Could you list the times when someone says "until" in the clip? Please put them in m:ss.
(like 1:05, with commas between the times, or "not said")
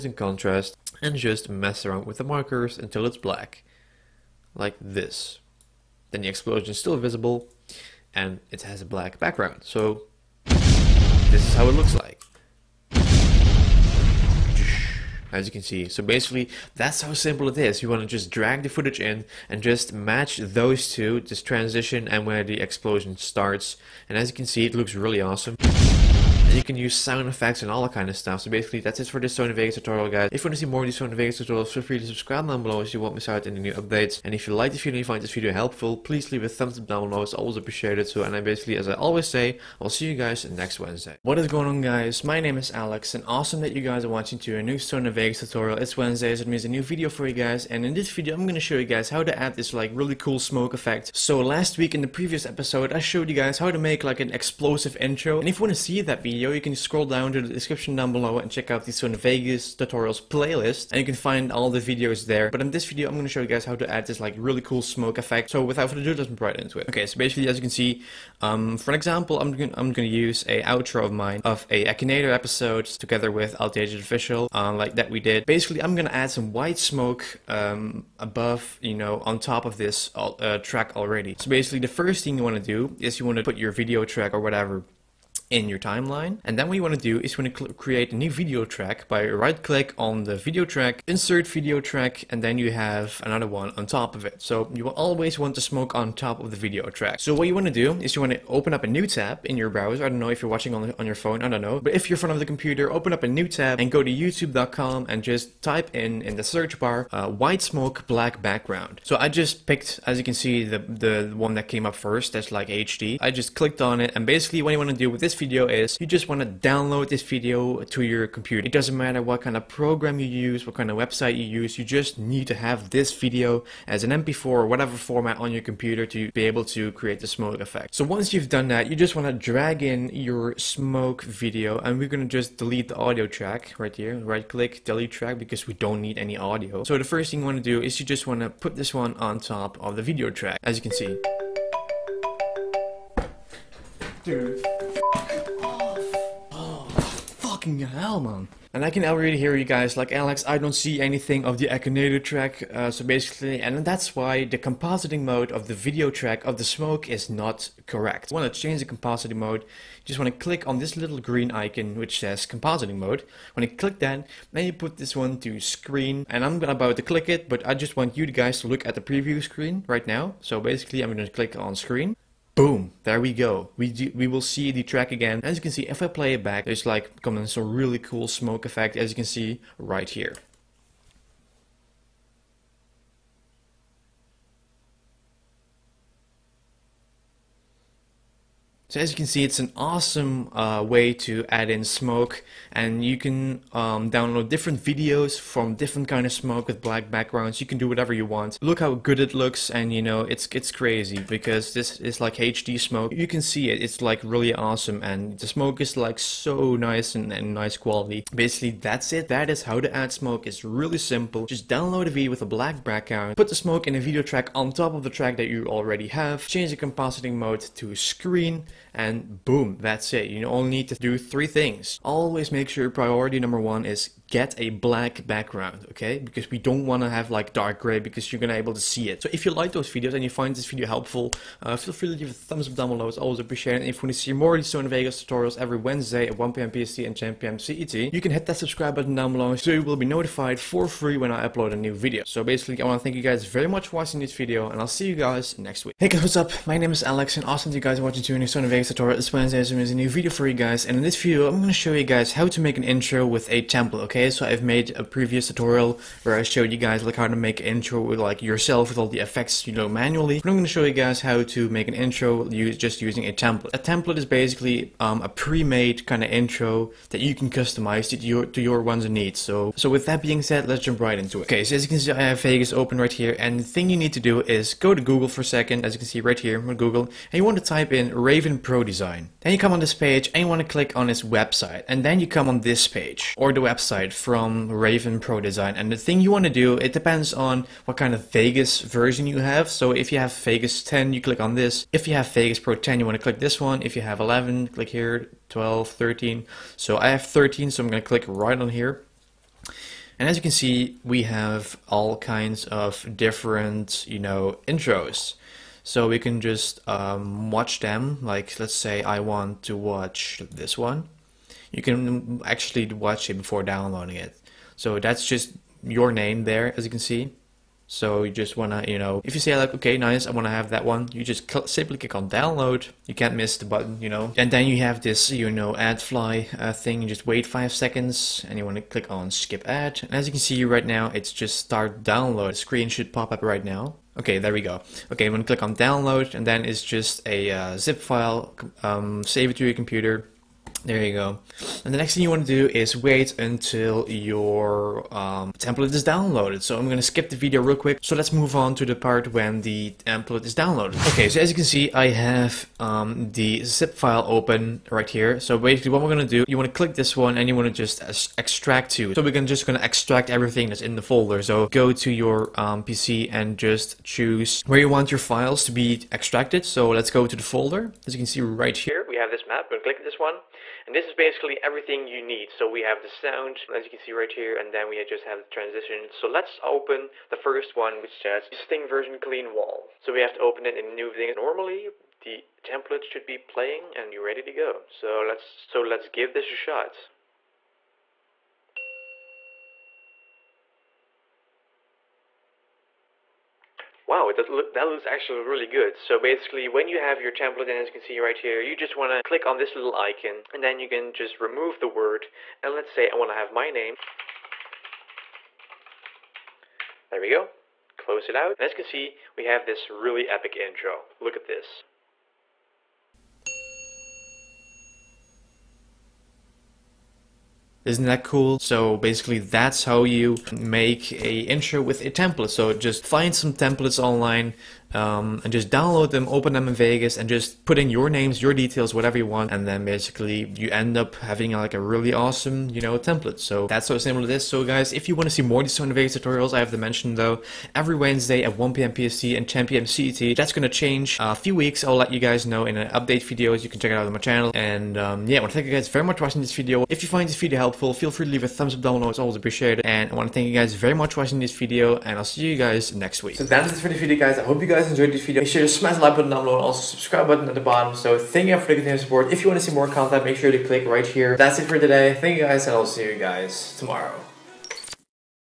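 0:02, 5:43.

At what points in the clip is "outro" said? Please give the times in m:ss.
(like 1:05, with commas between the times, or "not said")
1:10.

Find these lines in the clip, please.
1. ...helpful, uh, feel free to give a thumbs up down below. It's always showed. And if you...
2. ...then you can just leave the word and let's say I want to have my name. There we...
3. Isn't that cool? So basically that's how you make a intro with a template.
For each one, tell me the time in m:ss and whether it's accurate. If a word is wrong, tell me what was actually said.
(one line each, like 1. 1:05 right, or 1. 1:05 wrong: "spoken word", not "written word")
1. 3:50 wrong: "appreciated", not "showed"
2. 6:40 wrong: "remove", not "leave"
3. 6:57 right.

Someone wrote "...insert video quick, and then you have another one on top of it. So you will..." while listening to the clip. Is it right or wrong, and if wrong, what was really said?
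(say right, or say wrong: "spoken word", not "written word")
wrong: "track", not "quick".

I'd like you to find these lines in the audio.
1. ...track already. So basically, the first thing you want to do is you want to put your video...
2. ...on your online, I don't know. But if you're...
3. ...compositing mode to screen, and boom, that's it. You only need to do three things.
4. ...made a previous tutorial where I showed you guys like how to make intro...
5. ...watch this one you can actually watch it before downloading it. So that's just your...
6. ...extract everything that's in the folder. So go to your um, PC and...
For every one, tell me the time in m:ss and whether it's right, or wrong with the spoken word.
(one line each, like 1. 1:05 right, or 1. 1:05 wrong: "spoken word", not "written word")
1. 1:20 right
2. 1:40 wrong: "phone", not "online"
3. 3:36 right
4. 4:14 right
5. 5:09 right
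6. 5:59 right.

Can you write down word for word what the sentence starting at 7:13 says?
So that's so simple it is.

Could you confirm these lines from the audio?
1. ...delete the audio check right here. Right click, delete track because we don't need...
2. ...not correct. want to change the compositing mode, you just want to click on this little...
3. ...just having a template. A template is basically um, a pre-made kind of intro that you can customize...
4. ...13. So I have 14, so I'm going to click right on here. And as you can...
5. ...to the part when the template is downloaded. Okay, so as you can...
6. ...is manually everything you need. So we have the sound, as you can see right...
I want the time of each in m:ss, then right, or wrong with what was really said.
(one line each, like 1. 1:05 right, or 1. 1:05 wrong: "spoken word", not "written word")
1. 2:12 wrong: "track", not "check"
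2. 2:37 right
3. 4:22 wrong: "using", not "having"
4. 4:55 wrong: "13", not "14"
5. 5:48 right
6. 6:11 wrong: "basically", not "manually".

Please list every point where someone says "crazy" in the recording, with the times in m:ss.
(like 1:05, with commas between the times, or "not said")
3:20.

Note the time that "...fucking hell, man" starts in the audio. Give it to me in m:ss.
2:27.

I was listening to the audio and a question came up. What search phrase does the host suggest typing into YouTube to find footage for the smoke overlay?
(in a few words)
white smoke black background.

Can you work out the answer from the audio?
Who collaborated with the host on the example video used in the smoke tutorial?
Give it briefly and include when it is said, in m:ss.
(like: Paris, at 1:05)
Altaged Official, at 1:13.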